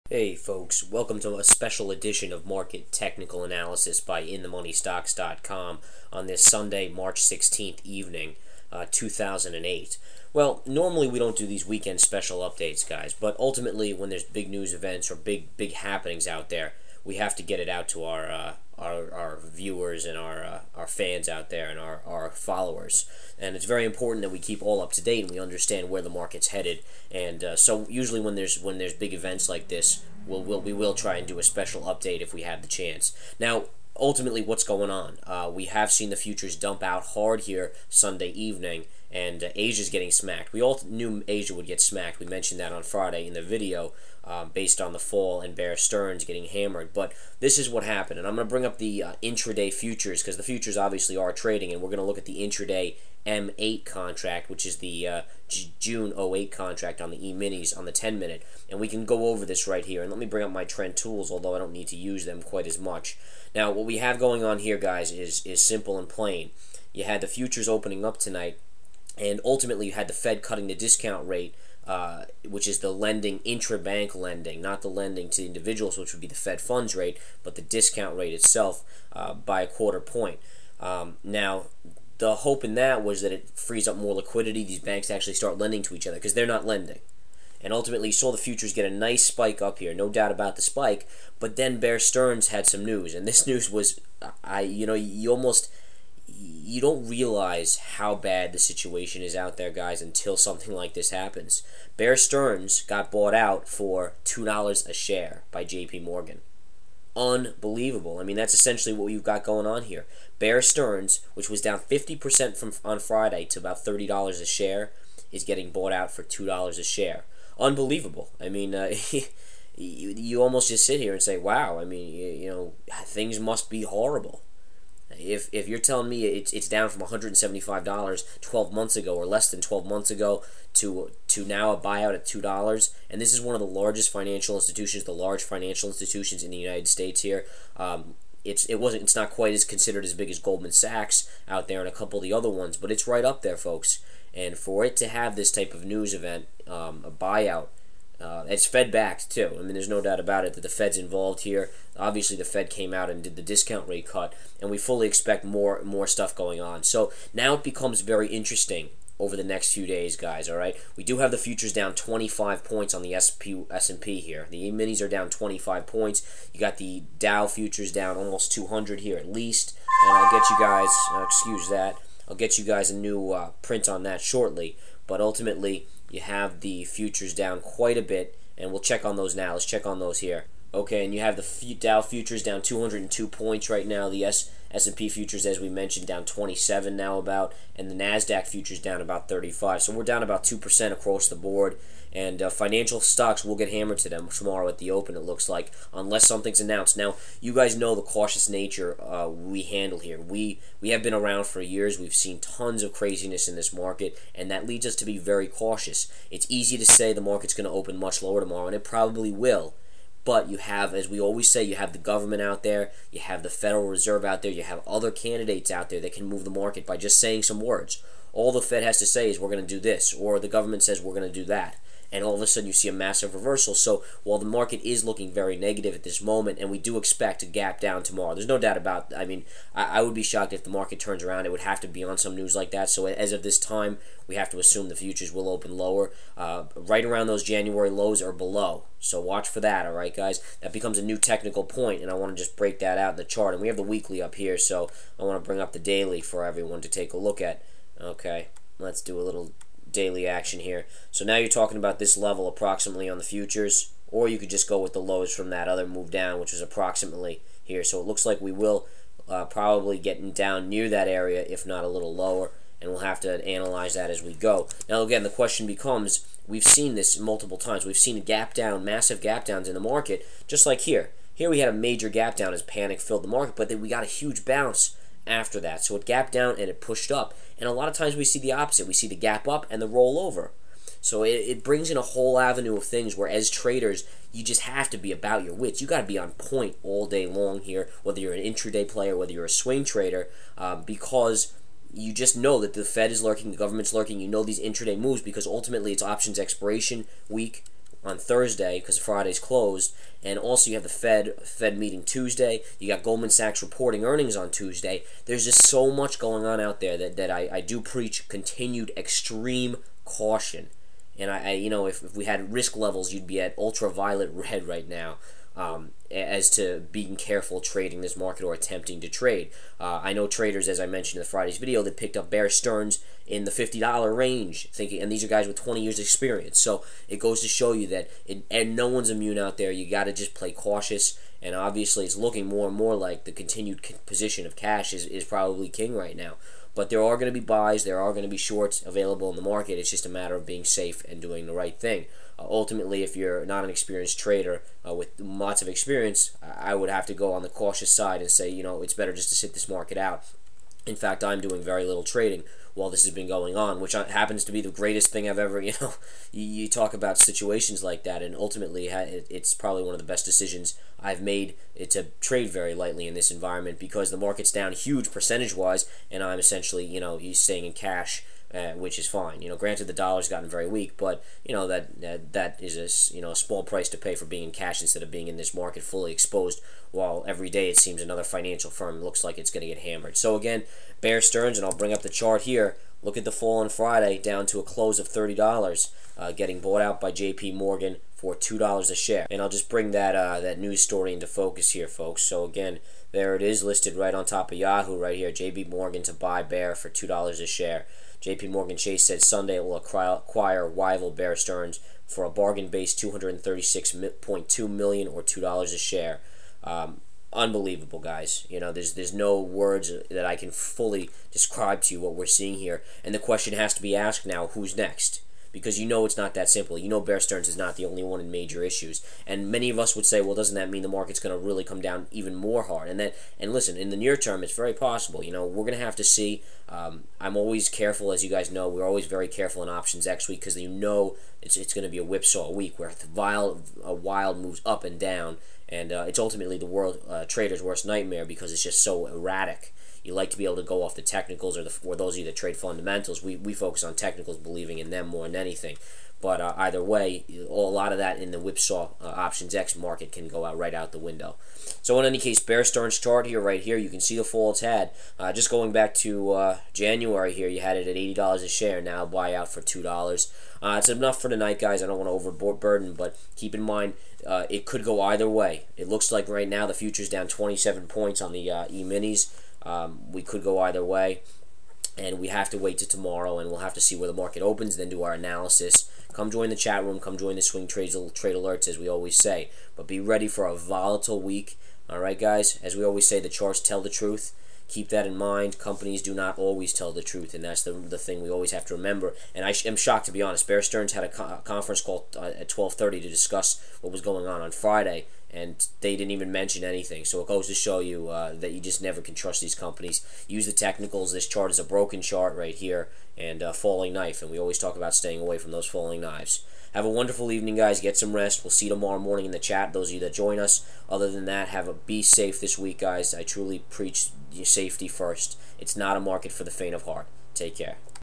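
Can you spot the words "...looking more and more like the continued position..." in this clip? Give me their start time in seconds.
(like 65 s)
332 s.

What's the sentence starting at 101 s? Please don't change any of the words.
Bear Stearns got bought out for $2 a share by JP Morgan.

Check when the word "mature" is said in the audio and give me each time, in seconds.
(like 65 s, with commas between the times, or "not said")
not said.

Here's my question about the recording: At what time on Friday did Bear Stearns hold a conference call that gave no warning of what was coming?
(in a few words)
12:30.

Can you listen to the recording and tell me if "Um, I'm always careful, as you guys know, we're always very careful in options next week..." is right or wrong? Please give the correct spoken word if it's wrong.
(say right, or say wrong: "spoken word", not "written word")
right.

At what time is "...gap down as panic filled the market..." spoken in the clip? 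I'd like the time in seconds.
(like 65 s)
272 s.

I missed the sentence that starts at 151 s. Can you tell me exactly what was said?
Obviously, the Fed came out and did the discount rate cut, and we fully expect more more stuff going on.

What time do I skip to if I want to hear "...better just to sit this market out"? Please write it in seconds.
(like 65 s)
348 s.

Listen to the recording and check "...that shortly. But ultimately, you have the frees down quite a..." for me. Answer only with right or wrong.
wrong.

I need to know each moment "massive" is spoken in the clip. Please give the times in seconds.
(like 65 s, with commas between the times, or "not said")
222 s, 268 s.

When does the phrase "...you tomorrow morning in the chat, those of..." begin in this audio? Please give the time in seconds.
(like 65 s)
508 s.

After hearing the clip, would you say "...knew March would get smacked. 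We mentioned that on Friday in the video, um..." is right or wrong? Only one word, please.
wrong.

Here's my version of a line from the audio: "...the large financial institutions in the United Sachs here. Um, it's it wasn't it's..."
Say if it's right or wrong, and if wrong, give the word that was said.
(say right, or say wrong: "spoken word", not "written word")
wrong: "States", not "Sachs".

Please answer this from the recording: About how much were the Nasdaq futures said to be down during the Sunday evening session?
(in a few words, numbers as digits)
About 35.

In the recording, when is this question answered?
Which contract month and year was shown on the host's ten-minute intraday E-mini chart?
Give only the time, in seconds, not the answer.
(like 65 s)
55 s.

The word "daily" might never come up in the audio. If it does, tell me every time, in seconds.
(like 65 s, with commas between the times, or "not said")
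245 s, 249 s.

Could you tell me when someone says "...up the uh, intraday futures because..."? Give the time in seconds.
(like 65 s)
48 s.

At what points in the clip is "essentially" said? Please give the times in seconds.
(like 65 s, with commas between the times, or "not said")
108 s, 366 s.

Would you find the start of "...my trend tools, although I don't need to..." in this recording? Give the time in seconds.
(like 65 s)
60 s.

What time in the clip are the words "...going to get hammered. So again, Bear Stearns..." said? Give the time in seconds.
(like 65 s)
379 s.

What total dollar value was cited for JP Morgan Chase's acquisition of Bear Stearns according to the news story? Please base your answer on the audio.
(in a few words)
236.2 million.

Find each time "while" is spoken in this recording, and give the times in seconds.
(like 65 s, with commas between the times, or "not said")
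224 s, 352 s, 376 s.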